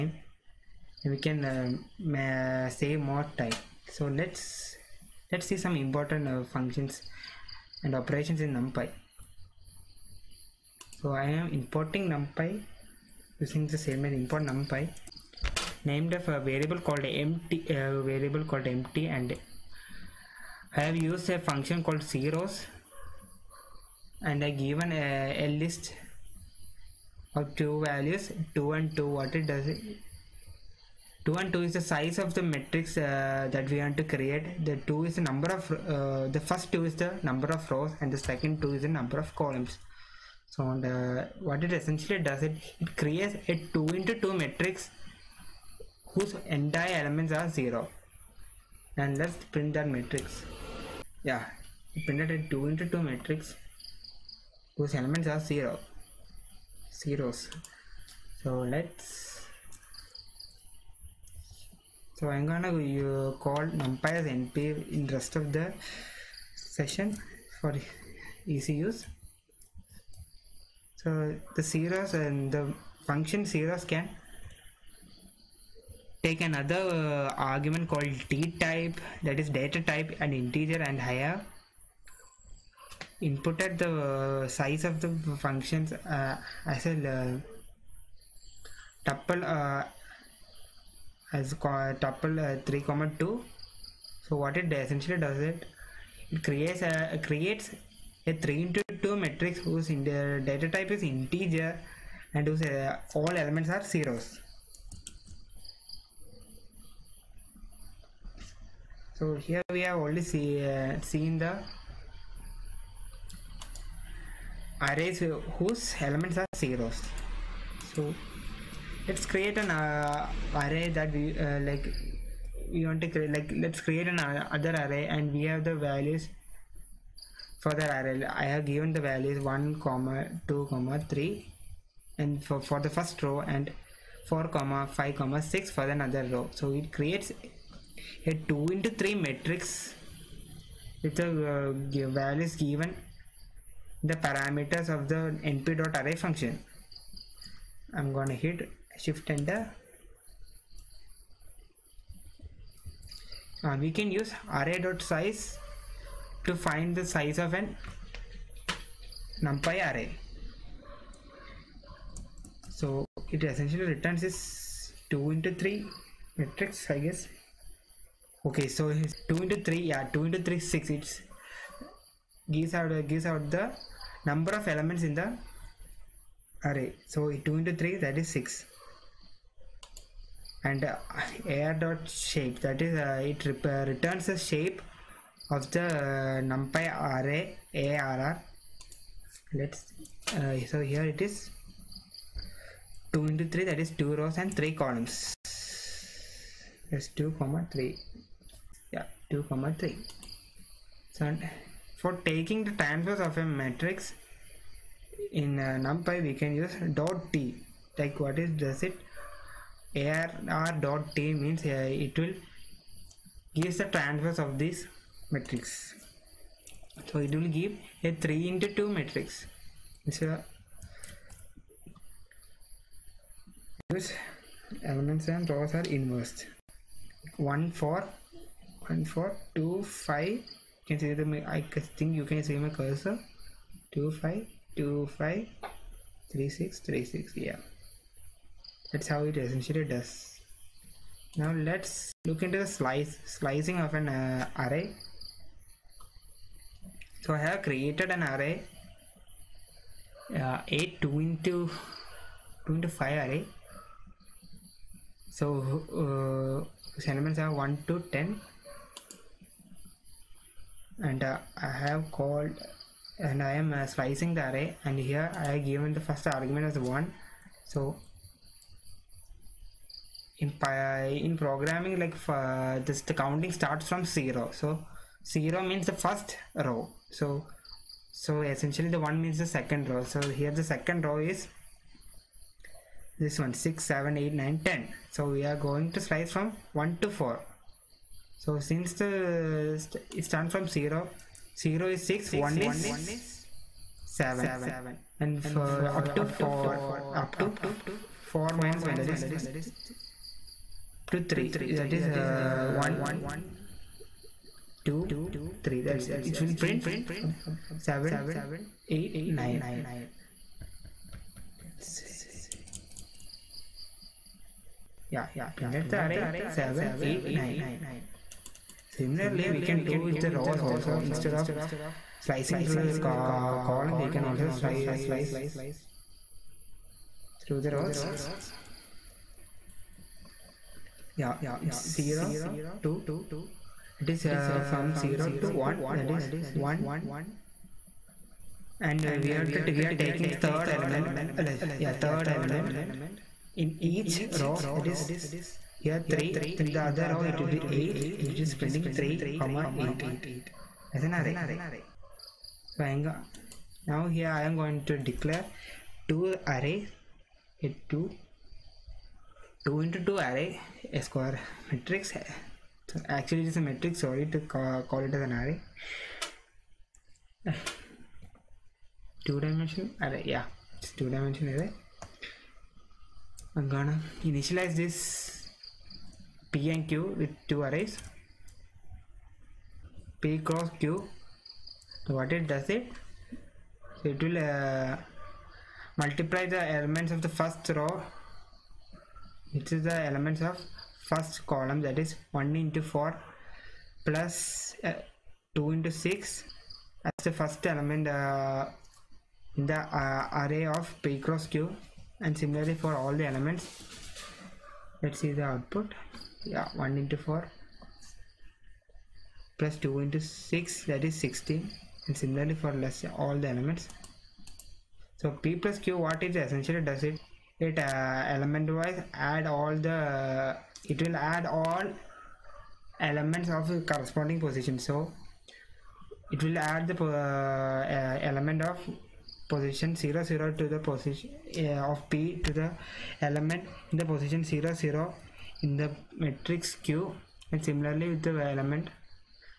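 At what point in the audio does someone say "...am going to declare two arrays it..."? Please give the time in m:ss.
5:54.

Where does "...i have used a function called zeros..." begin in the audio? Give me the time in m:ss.
0:20.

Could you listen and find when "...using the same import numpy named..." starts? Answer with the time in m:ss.
0:13.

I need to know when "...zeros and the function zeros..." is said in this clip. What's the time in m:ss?
1:11.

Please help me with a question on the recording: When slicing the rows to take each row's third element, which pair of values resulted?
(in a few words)
3 and 8.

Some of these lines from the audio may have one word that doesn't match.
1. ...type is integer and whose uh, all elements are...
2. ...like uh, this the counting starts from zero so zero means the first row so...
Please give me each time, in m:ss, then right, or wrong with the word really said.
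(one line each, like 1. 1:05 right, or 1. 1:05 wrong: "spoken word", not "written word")
1. 1:40 right
2. 4:31 right.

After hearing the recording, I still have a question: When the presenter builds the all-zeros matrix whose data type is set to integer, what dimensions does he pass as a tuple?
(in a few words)
3 by 2.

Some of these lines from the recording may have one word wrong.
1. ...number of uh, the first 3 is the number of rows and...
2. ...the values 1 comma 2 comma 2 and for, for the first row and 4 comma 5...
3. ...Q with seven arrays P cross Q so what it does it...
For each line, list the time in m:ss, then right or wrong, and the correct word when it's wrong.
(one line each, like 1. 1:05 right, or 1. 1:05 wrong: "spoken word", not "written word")
1. 0:35 wrong: "2", not "3"
2. 2:08 wrong: "3", not "2"
3. 6:16 wrong: "two", not "seven".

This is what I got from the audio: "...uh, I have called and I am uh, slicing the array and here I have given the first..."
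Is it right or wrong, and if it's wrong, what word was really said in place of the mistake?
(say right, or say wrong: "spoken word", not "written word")
right.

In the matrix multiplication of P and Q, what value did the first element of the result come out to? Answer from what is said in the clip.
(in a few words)
16.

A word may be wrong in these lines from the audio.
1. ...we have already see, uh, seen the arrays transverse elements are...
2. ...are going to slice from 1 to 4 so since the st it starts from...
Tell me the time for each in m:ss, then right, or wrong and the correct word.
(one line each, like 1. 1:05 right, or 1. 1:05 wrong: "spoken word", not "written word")
1. 1:49 wrong: "whose", not "transverse"
2. 4:45 right.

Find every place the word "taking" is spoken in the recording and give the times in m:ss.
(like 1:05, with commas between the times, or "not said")
3:22, 5:40.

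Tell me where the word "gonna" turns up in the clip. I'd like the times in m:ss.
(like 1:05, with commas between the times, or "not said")
1:02, 2:28, 6:13.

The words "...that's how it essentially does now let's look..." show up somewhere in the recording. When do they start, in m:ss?
3:58.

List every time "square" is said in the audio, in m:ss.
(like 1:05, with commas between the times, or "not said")
6:01.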